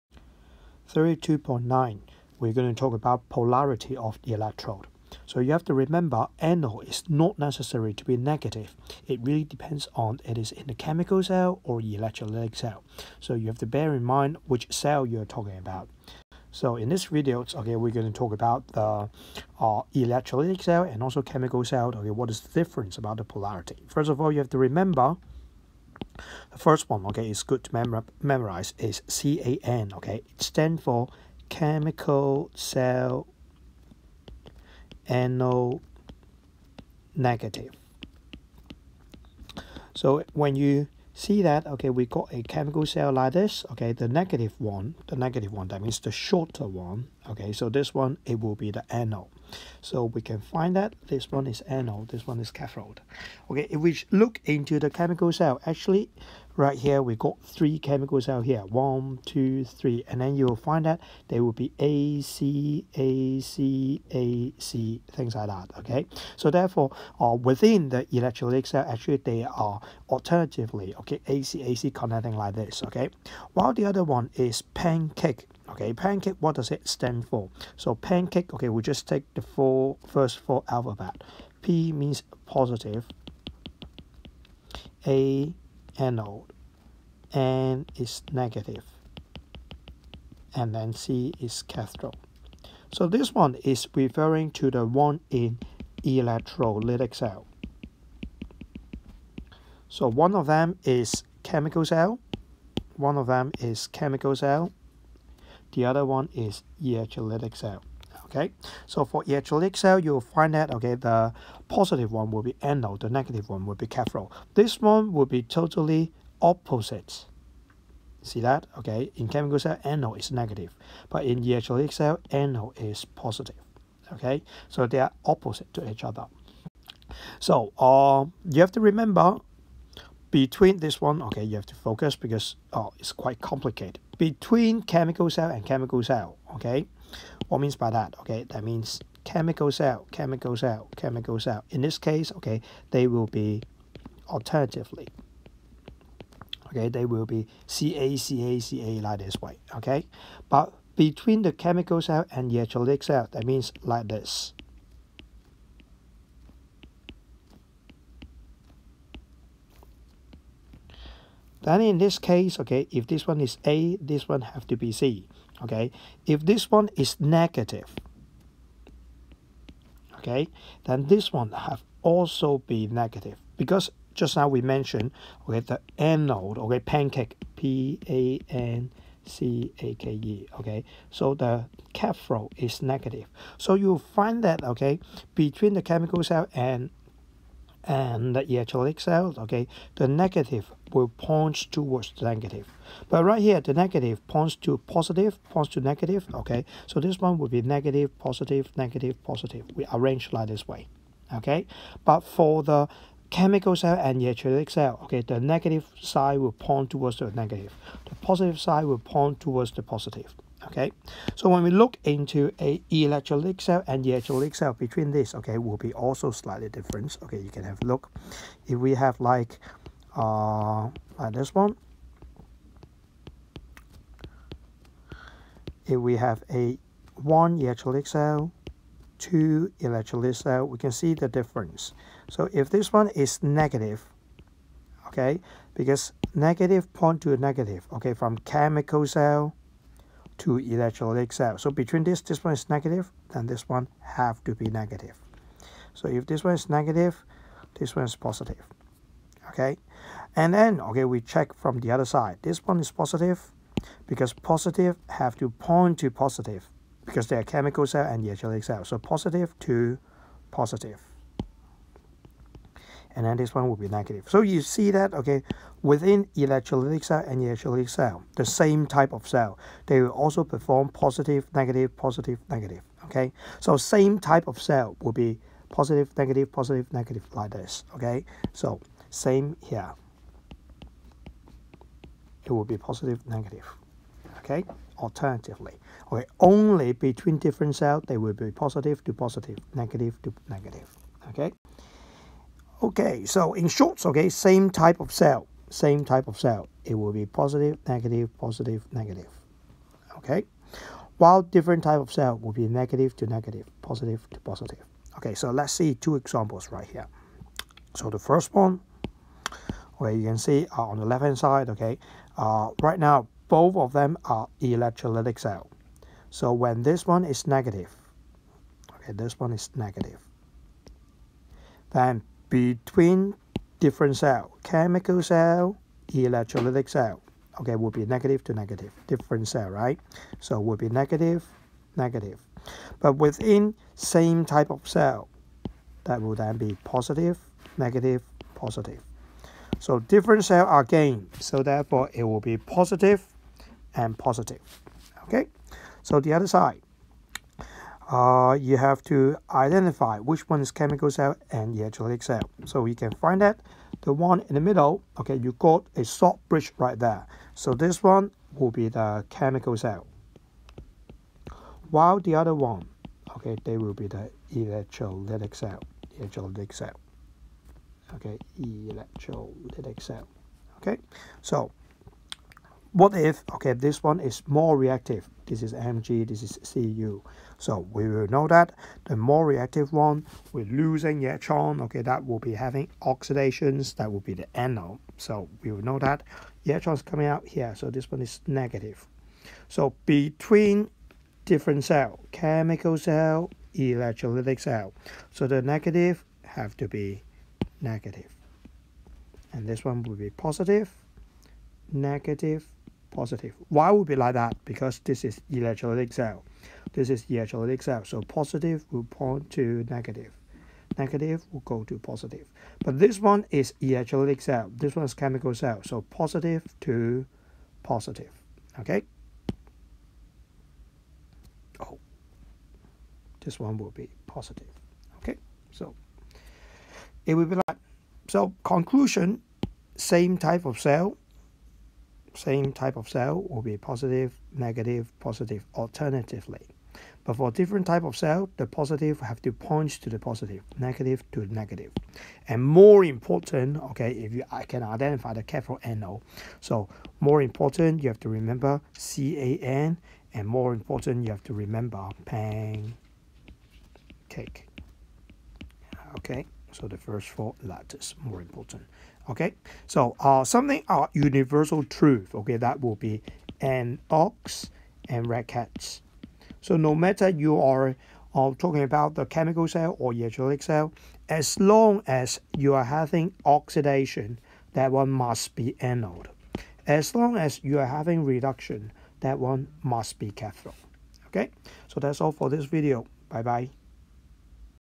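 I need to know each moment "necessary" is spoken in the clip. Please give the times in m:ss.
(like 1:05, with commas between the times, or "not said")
0:07.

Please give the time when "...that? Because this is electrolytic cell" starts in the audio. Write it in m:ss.
6:44.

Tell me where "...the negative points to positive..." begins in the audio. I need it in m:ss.
3:13.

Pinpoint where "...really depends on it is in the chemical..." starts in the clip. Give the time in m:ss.
0:09.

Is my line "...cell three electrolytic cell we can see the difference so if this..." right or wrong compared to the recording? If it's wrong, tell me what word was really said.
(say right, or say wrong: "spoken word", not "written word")
wrong: "two", not "three".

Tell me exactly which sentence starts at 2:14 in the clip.
Between chemical cell and chemical cell, okay?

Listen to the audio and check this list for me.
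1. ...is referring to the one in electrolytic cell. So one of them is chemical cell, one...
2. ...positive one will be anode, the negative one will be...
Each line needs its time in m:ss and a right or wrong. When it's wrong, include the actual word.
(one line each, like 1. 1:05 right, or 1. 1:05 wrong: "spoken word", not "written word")
1. 1:33 right
2. 1:51 right.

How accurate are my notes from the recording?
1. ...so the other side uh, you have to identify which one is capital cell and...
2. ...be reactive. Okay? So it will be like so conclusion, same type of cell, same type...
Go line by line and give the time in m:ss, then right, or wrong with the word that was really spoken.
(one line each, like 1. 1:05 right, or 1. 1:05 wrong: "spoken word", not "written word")
1. 5:46 wrong: "chemical", not "capital"
2. 7:03 wrong: "positive", not "reactive".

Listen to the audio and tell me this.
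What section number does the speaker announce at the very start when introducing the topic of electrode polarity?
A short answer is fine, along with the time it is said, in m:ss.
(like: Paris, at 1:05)
32.9, at 0:00.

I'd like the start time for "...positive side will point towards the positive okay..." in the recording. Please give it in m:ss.
3:28.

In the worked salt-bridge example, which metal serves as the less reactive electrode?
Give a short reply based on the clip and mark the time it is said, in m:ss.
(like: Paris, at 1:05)
CU, at 6:16.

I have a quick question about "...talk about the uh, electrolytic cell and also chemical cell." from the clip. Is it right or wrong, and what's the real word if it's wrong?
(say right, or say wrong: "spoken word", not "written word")
right.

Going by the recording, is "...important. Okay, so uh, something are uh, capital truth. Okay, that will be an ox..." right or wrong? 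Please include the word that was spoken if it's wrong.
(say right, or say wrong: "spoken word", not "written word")
wrong: "universal", not "capital".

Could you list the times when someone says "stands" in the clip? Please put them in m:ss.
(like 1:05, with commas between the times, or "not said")
0:30, 1:16.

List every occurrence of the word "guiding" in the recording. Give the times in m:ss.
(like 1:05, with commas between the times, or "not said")
not said.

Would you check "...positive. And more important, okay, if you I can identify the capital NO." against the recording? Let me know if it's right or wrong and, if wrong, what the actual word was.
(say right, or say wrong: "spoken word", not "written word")
wrong: "negative", not "positive".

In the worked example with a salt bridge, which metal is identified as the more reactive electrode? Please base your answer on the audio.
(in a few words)
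MG.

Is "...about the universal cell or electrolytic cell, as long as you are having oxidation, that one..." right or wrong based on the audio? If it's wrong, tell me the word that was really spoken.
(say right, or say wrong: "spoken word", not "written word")
wrong: "chemical", not "universal".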